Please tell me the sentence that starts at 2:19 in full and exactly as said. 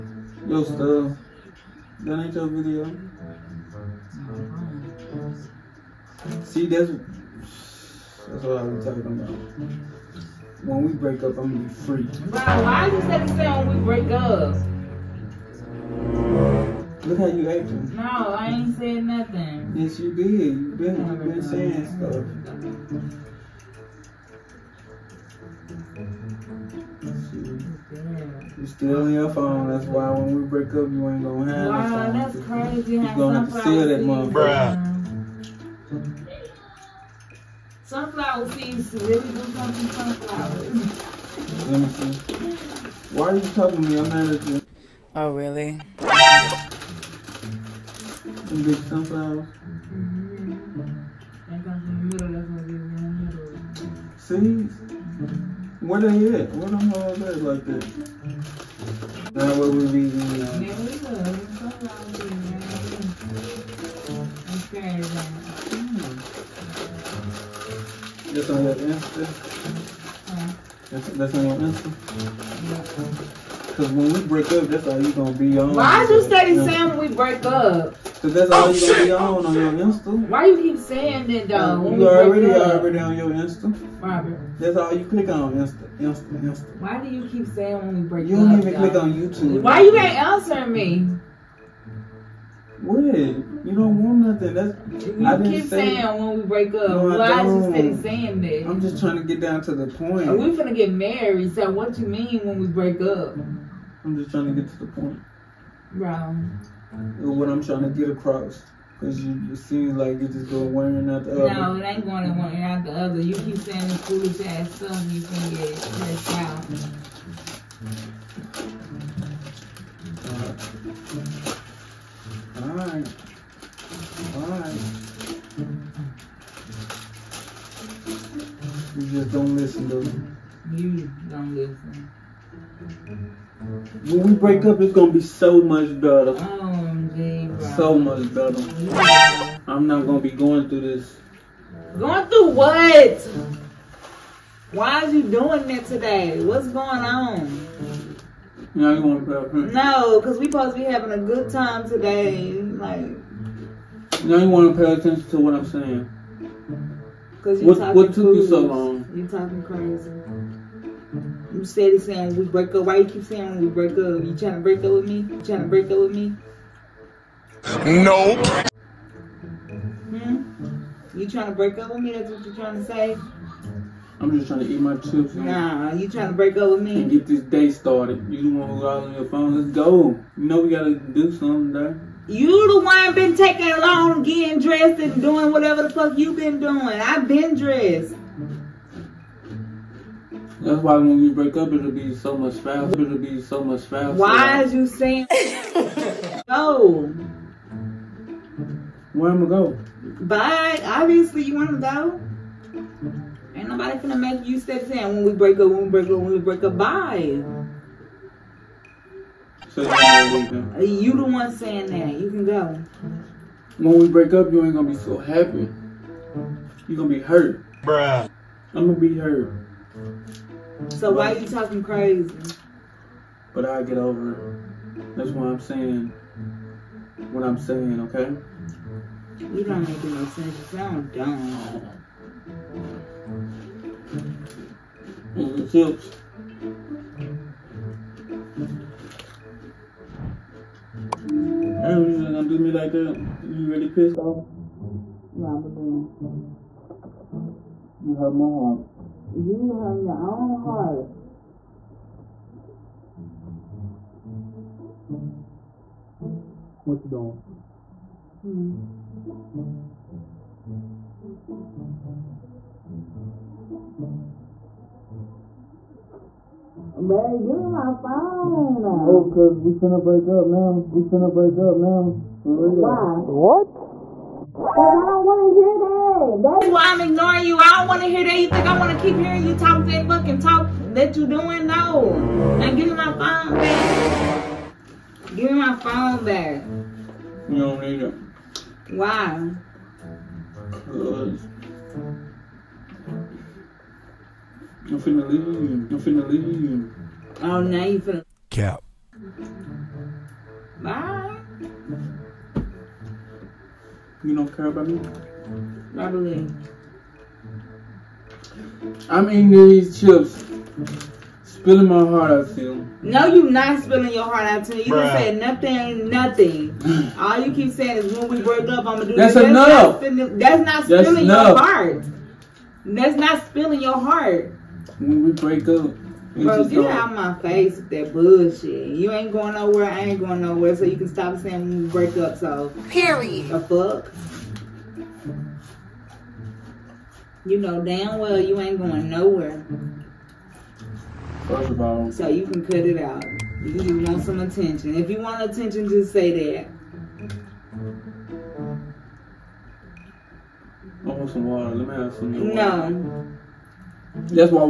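I'm not gonna be going through this.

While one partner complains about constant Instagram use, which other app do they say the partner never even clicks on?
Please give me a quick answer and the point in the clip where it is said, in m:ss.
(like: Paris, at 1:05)
YouTube, at 1:29.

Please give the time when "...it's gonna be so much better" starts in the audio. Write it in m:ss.
2:14.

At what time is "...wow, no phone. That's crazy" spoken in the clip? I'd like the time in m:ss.
0:31.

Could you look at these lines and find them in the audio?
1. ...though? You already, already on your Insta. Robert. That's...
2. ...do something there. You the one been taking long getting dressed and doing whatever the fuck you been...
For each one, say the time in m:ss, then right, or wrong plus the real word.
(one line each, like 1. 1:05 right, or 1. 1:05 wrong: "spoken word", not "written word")
1. 1:21 right
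2. 3:00 right.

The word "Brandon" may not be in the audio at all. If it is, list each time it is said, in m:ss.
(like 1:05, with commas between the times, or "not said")
not said.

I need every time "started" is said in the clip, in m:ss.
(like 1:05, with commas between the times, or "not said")
2:57.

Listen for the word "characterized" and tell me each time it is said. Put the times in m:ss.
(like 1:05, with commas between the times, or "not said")
not said.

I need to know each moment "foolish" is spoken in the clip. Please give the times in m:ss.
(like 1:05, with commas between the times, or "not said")
1:53.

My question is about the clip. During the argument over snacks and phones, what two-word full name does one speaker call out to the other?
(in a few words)
Robert Downey.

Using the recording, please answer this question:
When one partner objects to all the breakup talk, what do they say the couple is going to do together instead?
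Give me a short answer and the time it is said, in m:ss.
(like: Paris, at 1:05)
Get married, at 1:40.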